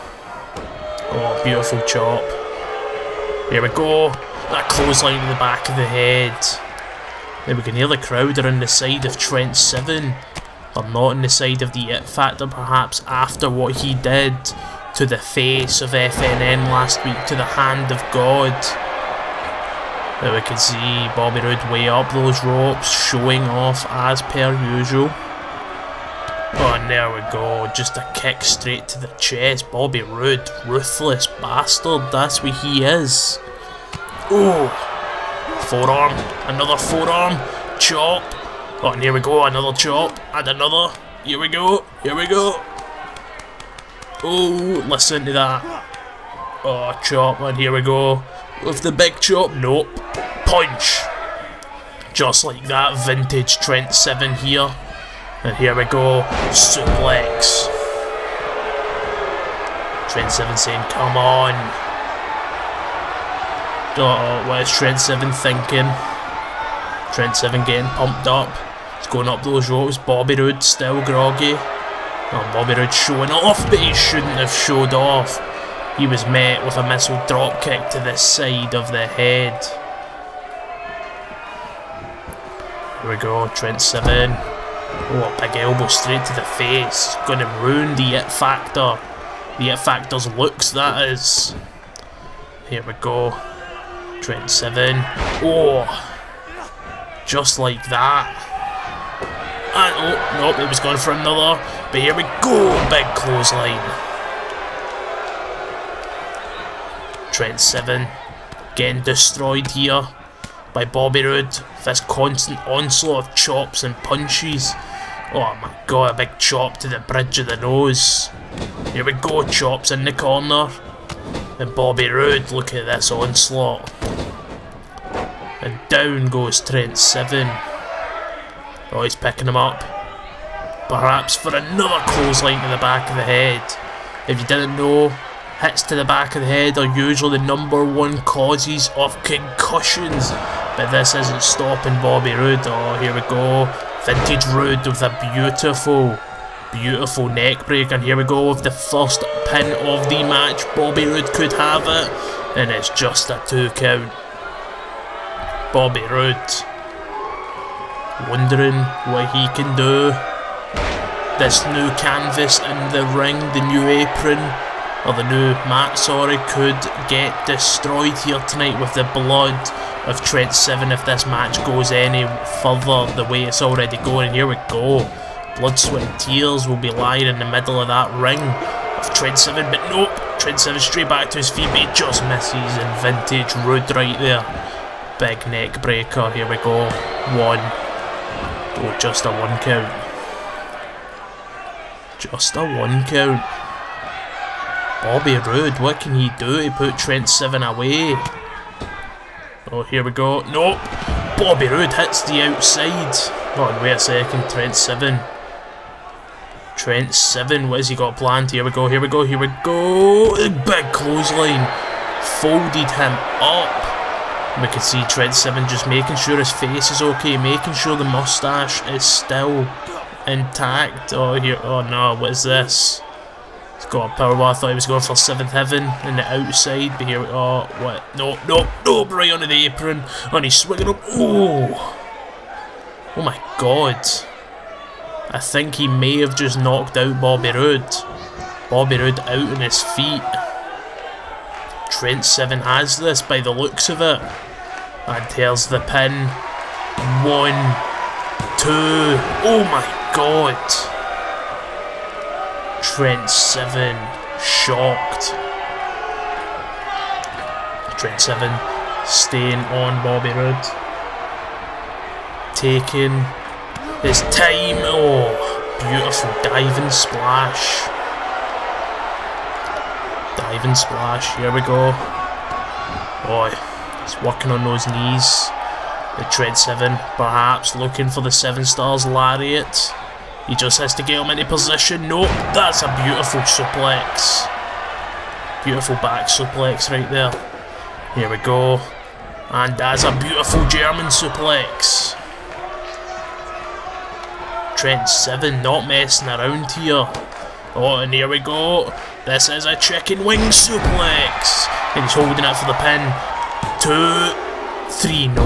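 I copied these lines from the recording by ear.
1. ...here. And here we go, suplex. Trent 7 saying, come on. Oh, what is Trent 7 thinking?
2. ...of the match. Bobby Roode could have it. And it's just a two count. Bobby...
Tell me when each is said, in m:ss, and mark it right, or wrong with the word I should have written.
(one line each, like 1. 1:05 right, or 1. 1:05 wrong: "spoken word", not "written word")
1. 0:54 right
2. 2:29 right.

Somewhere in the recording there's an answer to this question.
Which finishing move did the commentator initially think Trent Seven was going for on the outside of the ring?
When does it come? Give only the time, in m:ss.
3:45.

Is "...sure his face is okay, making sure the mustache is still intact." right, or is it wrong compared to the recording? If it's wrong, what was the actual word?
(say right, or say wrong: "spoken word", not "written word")
right.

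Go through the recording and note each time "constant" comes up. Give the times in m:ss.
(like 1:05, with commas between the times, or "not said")
1:52.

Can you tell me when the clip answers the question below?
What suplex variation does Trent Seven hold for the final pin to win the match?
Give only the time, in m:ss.
4:59.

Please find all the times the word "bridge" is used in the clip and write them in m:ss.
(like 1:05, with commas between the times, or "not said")
1:56.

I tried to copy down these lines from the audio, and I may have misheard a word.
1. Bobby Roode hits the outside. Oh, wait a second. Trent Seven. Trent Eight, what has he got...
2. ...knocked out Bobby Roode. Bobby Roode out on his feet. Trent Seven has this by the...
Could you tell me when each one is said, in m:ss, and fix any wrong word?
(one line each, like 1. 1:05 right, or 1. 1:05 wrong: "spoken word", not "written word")
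1. 3:21 wrong: "Seven", not "Eight"
2. 3:56 right.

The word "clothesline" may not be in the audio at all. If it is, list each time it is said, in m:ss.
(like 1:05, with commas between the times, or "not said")
0:04, 1:43, 2:12, 3:30.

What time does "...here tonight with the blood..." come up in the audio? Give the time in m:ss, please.
2:48.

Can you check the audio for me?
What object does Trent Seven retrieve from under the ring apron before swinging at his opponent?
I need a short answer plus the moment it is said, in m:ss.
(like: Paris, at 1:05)
Power bar, at 3:44.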